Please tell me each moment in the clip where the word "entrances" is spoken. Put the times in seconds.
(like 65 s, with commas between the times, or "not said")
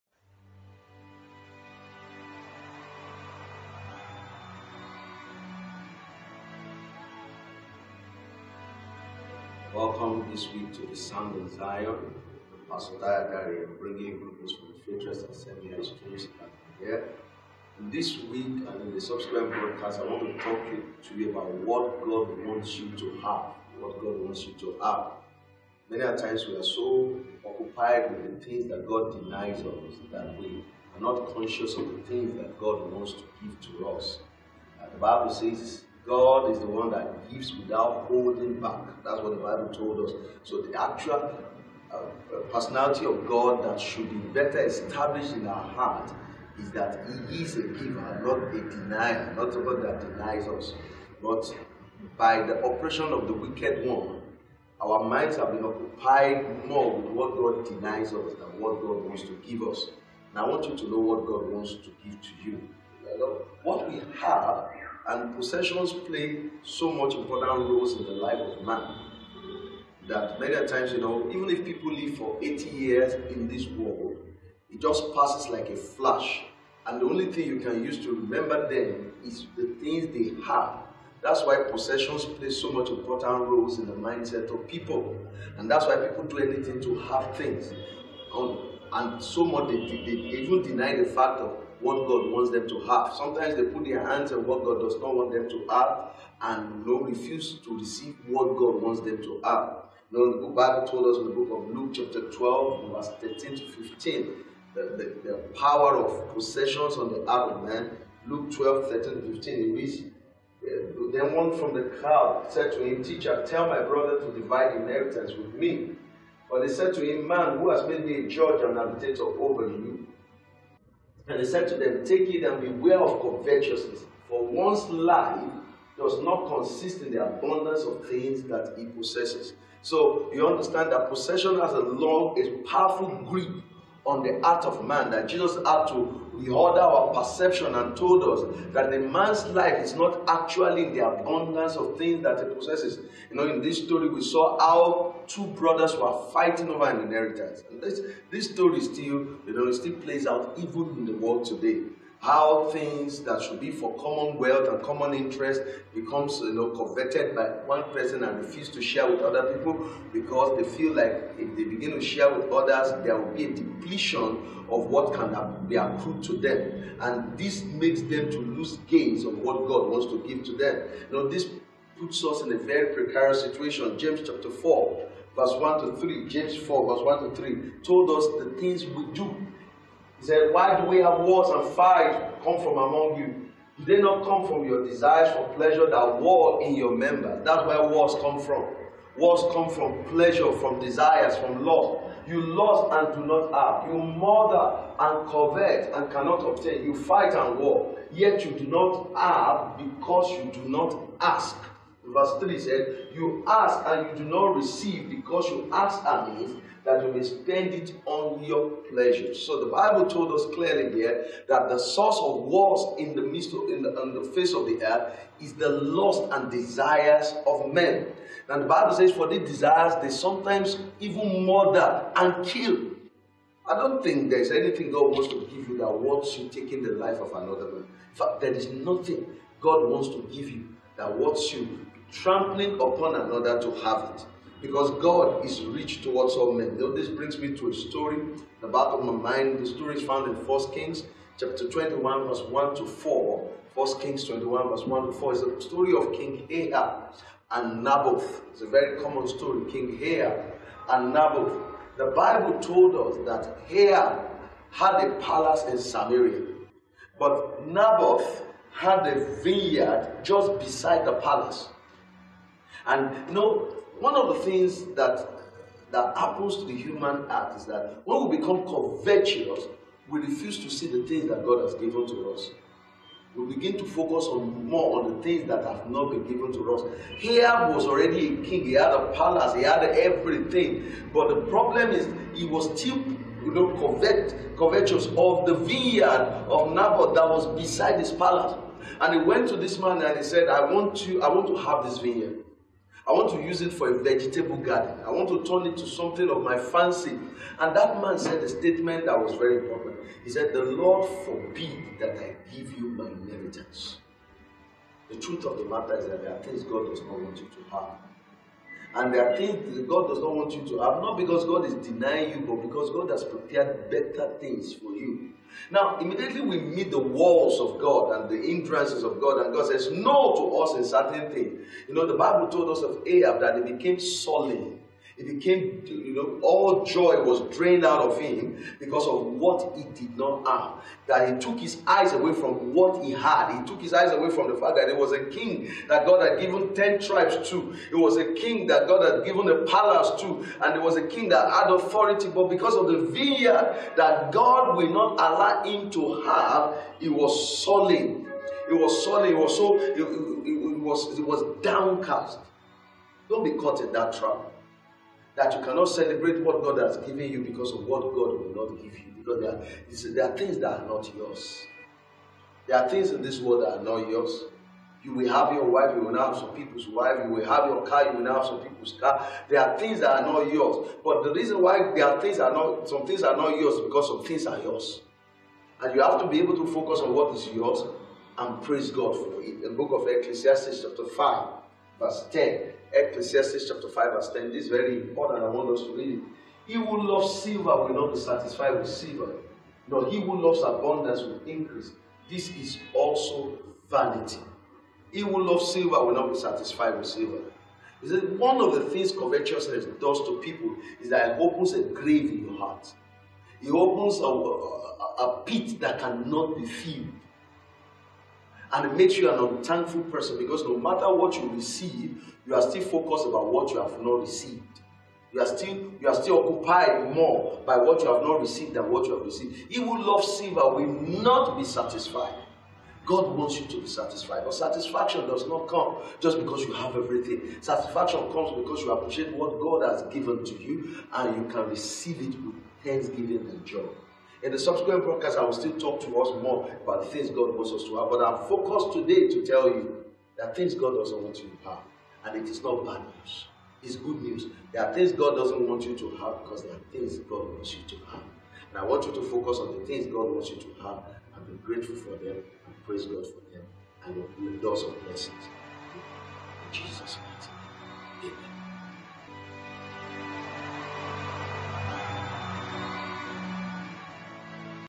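318 s.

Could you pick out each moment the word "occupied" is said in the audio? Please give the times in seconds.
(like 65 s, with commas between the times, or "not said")
27 s, 55 s, 416 s.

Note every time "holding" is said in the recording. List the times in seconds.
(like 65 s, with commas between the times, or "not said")
38 s.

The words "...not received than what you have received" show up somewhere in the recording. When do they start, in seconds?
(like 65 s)
418 s.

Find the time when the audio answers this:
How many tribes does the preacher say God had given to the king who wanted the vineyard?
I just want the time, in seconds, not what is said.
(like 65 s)
336 s.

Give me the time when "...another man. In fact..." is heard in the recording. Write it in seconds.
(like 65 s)
227 s.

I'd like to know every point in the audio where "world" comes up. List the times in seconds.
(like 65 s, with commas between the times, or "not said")
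73 s, 151 s, 363 s.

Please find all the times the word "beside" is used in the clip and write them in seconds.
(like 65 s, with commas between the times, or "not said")
260 s, 287 s.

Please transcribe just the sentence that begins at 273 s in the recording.
We begin to focus on more on the things that have not been given to us.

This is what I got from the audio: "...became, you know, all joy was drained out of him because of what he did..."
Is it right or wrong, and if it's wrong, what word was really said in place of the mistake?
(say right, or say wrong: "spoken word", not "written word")
right.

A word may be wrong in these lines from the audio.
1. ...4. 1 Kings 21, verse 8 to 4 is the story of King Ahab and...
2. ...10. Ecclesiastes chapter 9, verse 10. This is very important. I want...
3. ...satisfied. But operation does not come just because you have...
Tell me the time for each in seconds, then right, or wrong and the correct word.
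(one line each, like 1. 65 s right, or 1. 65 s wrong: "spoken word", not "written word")
1. 242 s wrong: "1", not "8"
2. 382 s wrong: "5", not "9"
3. 423 s wrong: "satisfaction", not "operation".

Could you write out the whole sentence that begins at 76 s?
And the only thing you can use to remember them is the things they have.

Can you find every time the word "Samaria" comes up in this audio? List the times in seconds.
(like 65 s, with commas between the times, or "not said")
255 s.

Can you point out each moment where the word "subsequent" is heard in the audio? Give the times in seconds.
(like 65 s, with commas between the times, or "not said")
19 s, 434 s.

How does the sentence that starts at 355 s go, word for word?
That you cannot celebrate what God has given you because of what God will not give you.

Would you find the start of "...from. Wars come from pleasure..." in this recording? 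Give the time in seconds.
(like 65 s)
188 s.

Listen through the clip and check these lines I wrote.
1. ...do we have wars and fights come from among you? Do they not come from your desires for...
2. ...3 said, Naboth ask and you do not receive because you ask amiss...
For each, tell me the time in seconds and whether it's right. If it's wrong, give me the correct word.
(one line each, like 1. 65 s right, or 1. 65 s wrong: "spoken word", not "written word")
1. 180 s right
2. 202 s wrong: "You", not "Naboth".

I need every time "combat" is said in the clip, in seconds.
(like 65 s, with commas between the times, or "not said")
not said.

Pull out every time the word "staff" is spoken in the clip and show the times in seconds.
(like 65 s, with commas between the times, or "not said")
not said.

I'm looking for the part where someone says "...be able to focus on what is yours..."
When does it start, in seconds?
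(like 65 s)
376 s.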